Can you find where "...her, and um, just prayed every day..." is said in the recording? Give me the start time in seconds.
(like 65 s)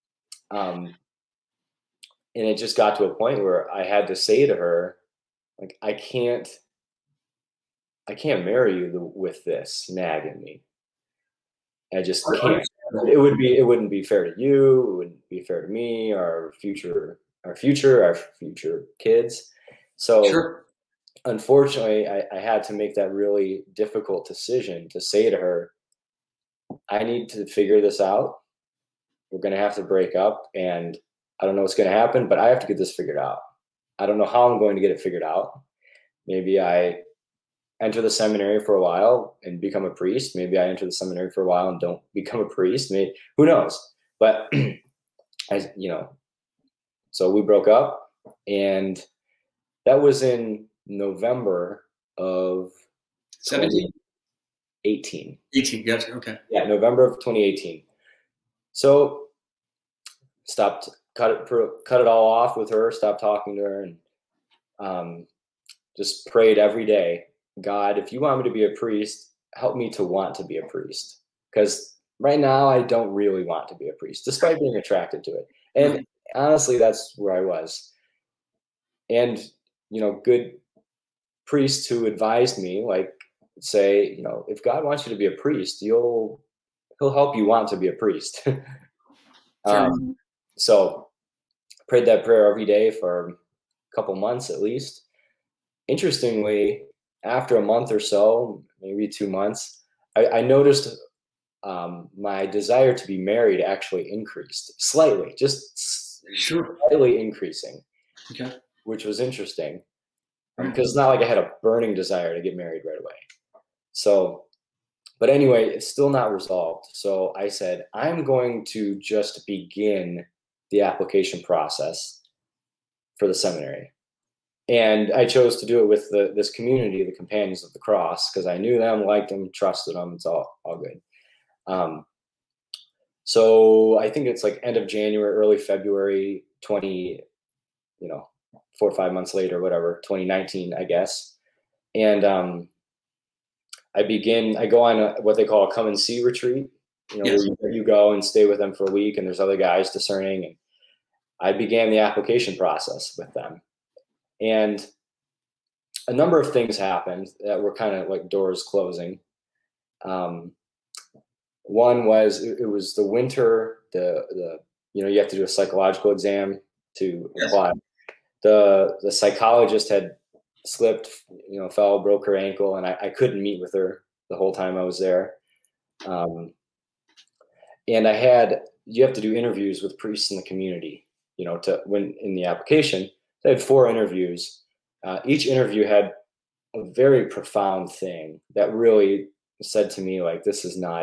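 63 s.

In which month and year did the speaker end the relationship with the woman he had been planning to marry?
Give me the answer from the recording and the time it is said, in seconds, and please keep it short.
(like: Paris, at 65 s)
November 2018, at 56 s.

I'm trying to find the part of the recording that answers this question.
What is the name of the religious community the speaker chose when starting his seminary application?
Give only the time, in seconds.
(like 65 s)
127 s.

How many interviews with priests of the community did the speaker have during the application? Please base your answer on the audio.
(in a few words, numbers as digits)
4.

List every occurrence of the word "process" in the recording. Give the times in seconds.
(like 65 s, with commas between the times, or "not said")
121 s, 152 s.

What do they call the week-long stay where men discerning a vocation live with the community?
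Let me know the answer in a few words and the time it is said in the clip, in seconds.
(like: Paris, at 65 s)
come and see retreat, at 145 s.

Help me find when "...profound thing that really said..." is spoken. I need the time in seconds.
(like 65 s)
187 s.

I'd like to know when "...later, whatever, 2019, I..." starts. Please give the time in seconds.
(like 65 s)
139 s.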